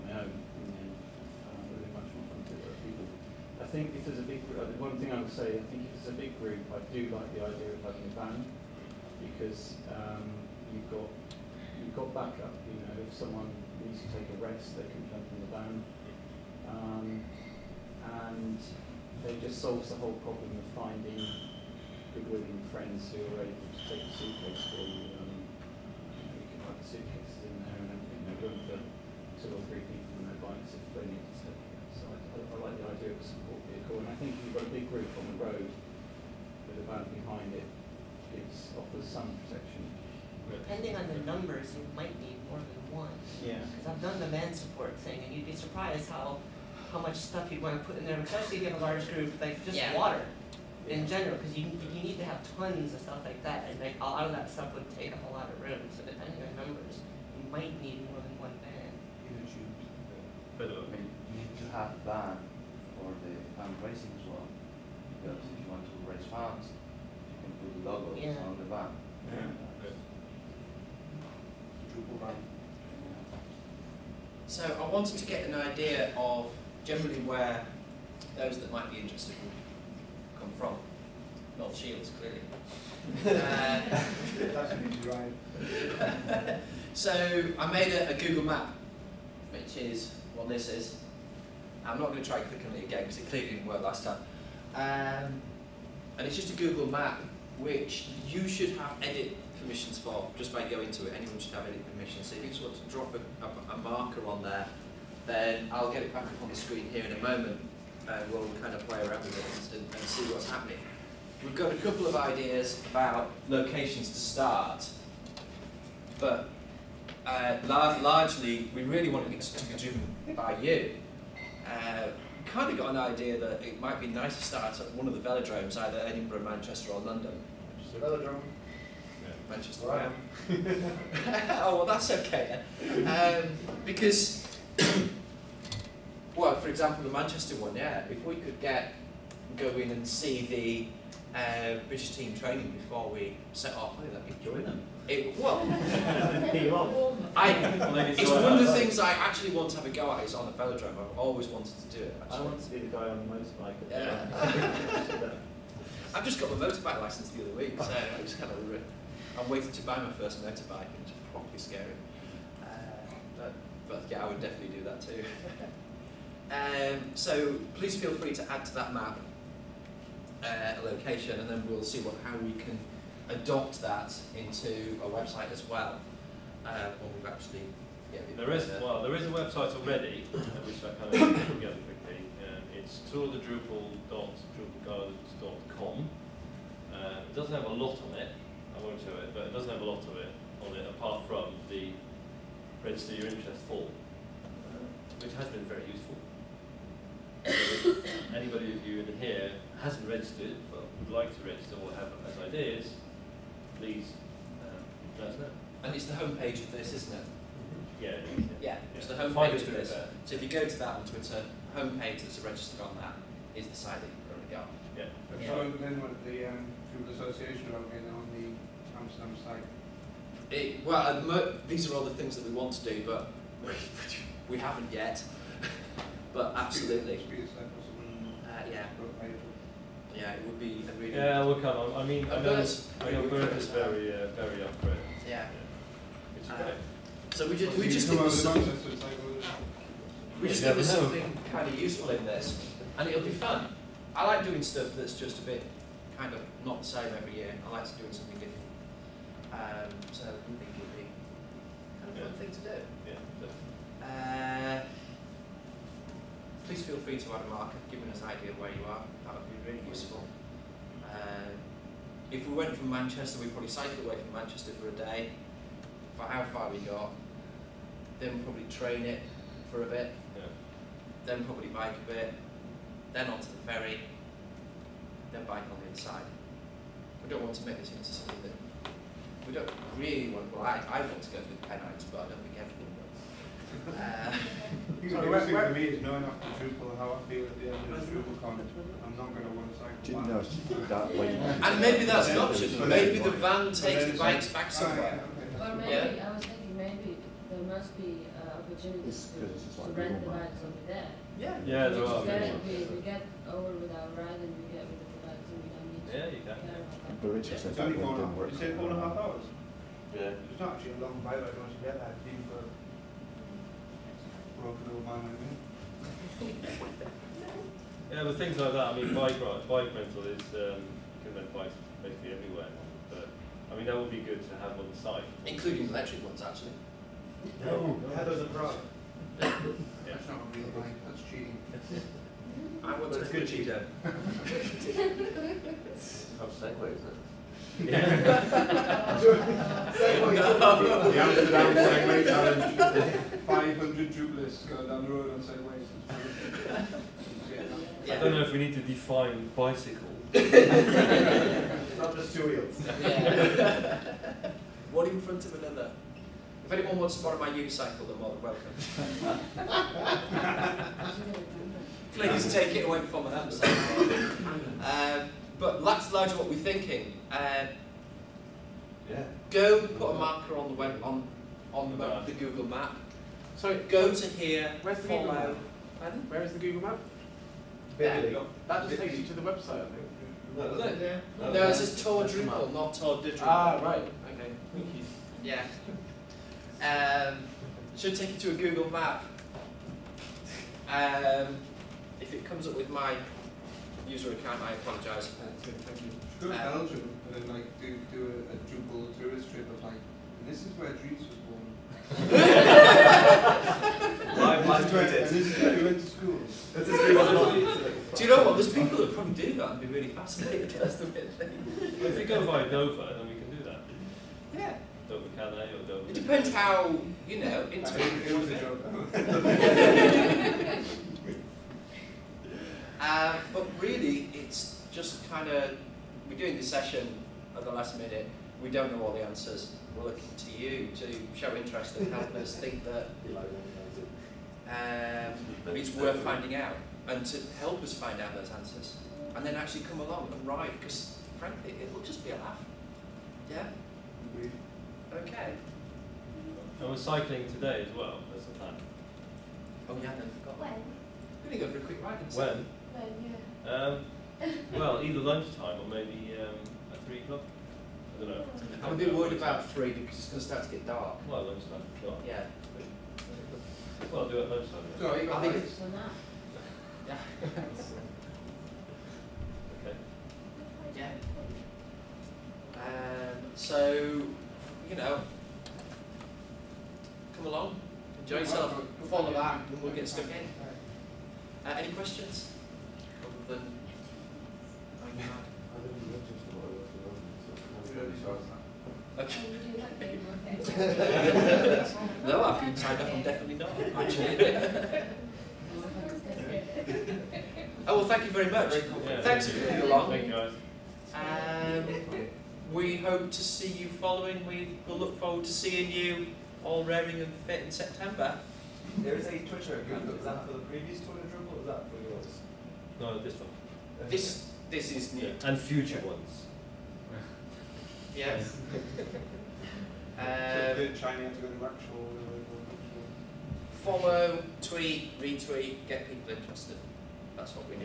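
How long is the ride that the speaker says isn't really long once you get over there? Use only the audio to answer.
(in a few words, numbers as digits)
4.5 hours.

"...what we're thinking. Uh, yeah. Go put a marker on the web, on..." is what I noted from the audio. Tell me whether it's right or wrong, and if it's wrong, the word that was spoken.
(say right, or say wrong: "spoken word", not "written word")
right.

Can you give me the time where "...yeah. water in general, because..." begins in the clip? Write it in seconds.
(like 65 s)
49 s.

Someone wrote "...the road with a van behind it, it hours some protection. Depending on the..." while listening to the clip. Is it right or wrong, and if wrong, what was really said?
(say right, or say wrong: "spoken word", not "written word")
wrong: "offers", not "hours".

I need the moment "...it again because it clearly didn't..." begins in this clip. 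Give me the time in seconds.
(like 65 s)
92 s.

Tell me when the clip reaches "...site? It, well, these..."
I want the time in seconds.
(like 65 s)
219 s.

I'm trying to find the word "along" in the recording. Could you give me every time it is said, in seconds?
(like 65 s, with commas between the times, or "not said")
440 s, 477 s, 499 s.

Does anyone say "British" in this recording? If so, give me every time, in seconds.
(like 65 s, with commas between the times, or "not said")
141 s.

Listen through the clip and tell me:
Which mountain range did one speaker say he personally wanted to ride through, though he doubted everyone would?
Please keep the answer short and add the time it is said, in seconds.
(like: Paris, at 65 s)
The Pennines, at 281 s.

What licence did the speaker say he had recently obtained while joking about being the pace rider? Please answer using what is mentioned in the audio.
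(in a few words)
Motorbike license.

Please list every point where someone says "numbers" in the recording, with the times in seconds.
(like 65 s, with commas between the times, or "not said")
41 s, 56 s.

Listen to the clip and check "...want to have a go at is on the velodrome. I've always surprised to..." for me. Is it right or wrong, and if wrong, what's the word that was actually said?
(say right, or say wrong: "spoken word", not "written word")
wrong: "wanted", not "surprised".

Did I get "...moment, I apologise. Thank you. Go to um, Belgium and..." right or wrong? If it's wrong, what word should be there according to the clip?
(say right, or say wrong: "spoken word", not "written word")
wrong: "account", not "moment".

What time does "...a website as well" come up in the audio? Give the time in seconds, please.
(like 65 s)
175 s.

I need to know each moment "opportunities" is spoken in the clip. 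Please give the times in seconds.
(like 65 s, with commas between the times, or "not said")
298 s.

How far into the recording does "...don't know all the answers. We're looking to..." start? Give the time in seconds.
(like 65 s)
428 s.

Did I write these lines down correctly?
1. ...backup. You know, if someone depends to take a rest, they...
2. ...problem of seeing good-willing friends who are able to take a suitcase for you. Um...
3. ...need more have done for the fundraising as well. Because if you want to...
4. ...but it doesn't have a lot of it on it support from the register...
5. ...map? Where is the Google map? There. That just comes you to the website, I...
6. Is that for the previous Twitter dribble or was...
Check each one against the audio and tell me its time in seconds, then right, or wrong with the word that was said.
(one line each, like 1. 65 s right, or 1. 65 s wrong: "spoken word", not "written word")
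1. 12 s wrong: "needs", not "depends"
2. 20 s wrong: "finding", not "seeing"
3. 57 s right
4. 189 s wrong: "apart", not "support"
5. 375 s wrong: "takes", not "comes"
6. 510 s right.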